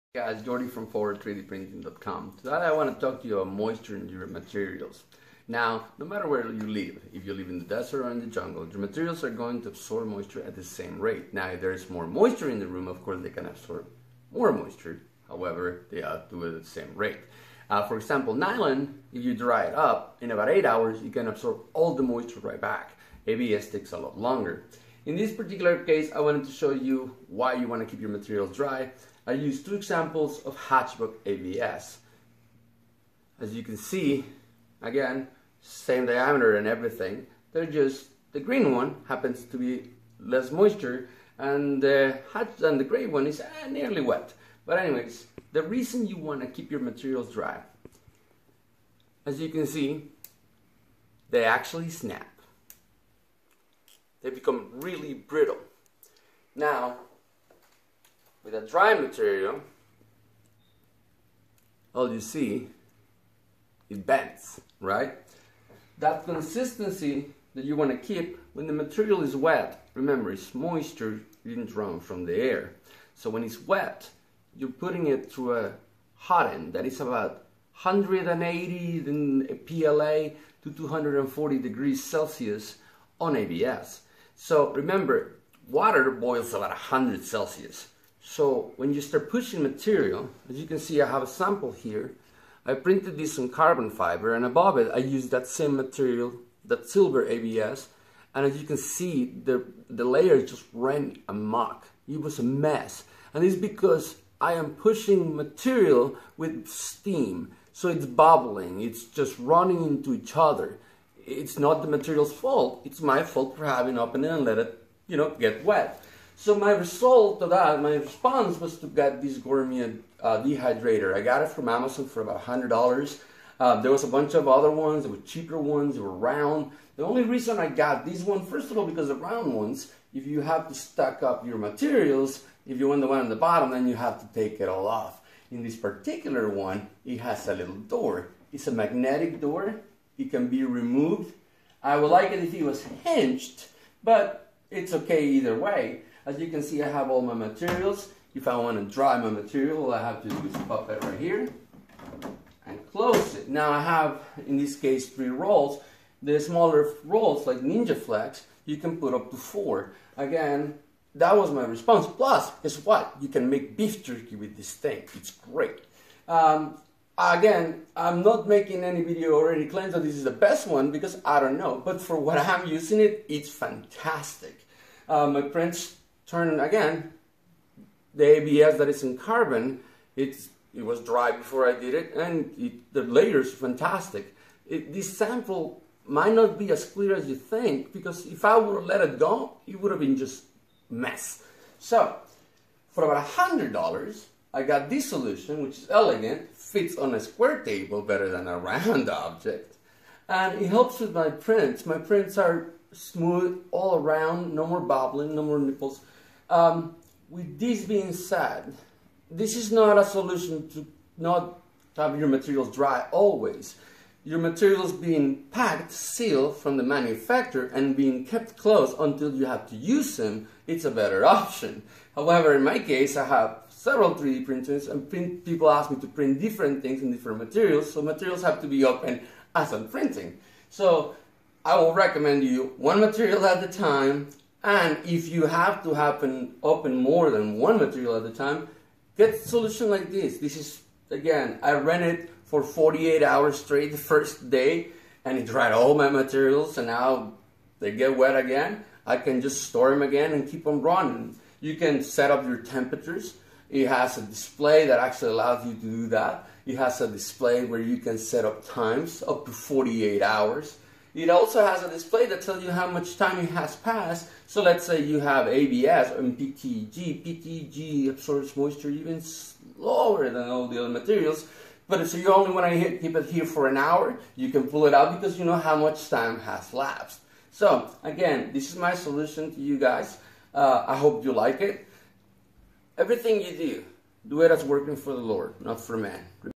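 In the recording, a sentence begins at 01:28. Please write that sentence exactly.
So when you start pushing material, as you can see, I have a sample here.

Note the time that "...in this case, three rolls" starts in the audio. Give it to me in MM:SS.
02:34.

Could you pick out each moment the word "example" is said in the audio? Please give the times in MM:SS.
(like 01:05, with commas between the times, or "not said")
00:17, 00:29.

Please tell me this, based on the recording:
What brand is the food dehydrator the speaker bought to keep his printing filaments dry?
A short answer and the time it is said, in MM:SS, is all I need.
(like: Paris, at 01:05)
Gourmia, at 01:59.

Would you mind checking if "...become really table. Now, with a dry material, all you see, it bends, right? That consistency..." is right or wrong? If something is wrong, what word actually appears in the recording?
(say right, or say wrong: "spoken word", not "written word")
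wrong: "brittle", not "table".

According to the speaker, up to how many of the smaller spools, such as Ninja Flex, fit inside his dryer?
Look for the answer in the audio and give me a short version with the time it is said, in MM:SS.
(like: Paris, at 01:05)
4, at 02:39.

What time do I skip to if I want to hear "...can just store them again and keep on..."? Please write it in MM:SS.
04:09.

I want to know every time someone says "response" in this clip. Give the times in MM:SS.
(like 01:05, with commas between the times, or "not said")
01:57, 02:41.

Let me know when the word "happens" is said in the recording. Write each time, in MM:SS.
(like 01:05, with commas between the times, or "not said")
00:39, 03:55.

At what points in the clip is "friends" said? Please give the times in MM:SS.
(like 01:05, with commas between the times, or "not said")
02:55.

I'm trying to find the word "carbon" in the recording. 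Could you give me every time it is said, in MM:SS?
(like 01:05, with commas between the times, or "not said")
01:33, 02:59.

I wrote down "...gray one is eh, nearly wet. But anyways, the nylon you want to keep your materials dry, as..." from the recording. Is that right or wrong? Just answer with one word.
wrong.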